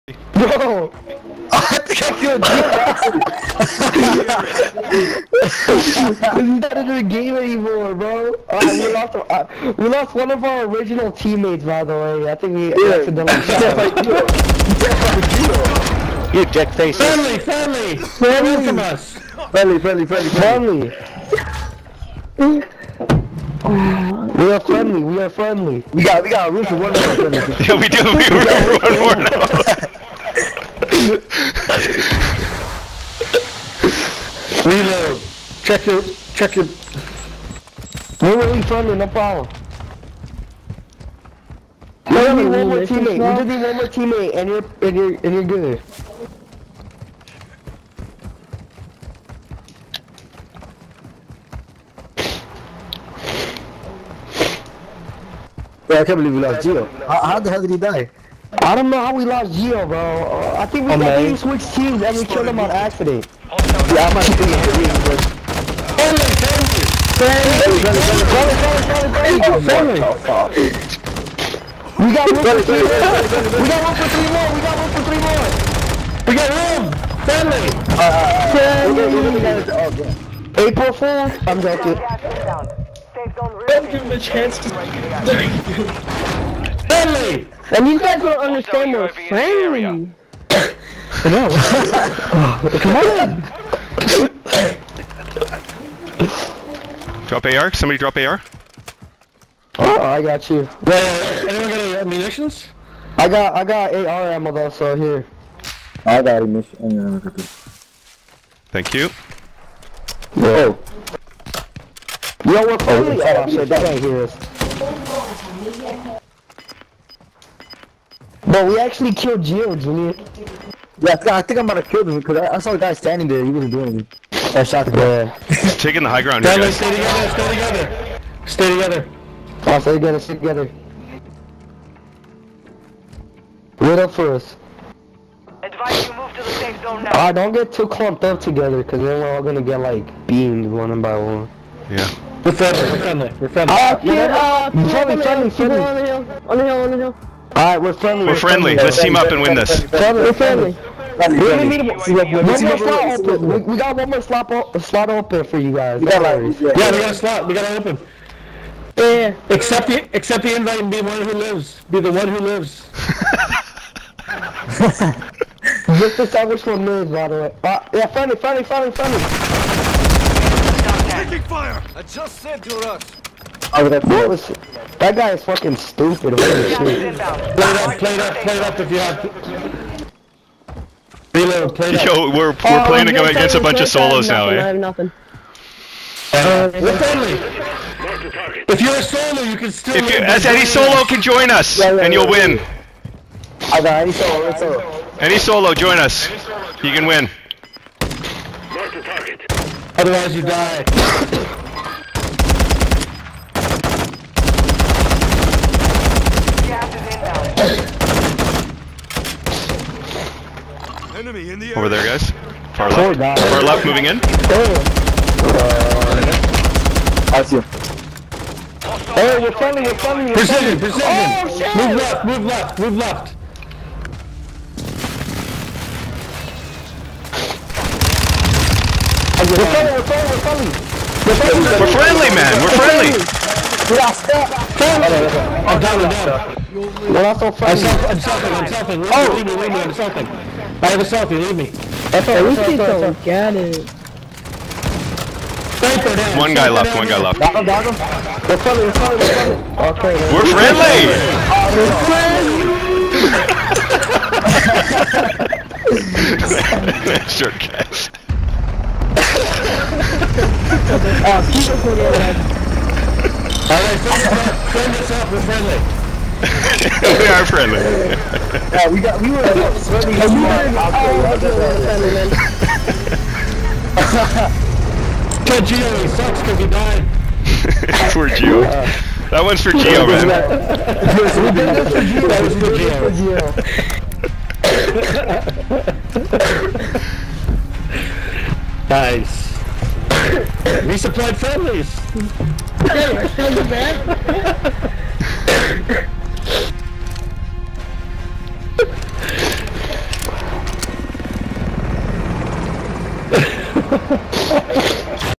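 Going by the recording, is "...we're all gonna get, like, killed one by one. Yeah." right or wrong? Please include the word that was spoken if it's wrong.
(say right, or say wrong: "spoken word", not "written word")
wrong: "beamed", not "killed".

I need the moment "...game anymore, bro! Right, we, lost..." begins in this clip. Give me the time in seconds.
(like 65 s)
7 s.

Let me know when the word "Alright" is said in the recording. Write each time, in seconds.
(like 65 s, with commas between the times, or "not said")
147 s, 263 s.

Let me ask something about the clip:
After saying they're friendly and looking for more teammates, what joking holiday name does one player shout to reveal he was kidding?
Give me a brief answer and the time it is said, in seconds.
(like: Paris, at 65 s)
April Fool's, at 80 s.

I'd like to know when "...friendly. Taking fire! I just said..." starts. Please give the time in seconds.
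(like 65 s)
168 s.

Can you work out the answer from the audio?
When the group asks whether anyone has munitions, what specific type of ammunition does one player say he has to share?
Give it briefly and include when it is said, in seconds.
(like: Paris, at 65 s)
AR ammo, at 103 s.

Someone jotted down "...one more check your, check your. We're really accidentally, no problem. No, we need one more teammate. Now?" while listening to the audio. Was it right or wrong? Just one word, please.
wrong.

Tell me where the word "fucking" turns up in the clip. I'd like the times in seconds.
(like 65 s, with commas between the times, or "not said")
175 s.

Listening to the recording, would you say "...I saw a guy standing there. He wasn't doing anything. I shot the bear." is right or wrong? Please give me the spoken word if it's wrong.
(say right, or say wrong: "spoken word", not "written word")
right.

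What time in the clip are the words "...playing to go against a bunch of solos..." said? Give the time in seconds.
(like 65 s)
182 s.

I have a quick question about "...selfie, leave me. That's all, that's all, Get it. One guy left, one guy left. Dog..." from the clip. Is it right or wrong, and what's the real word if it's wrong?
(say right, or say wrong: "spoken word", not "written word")
right.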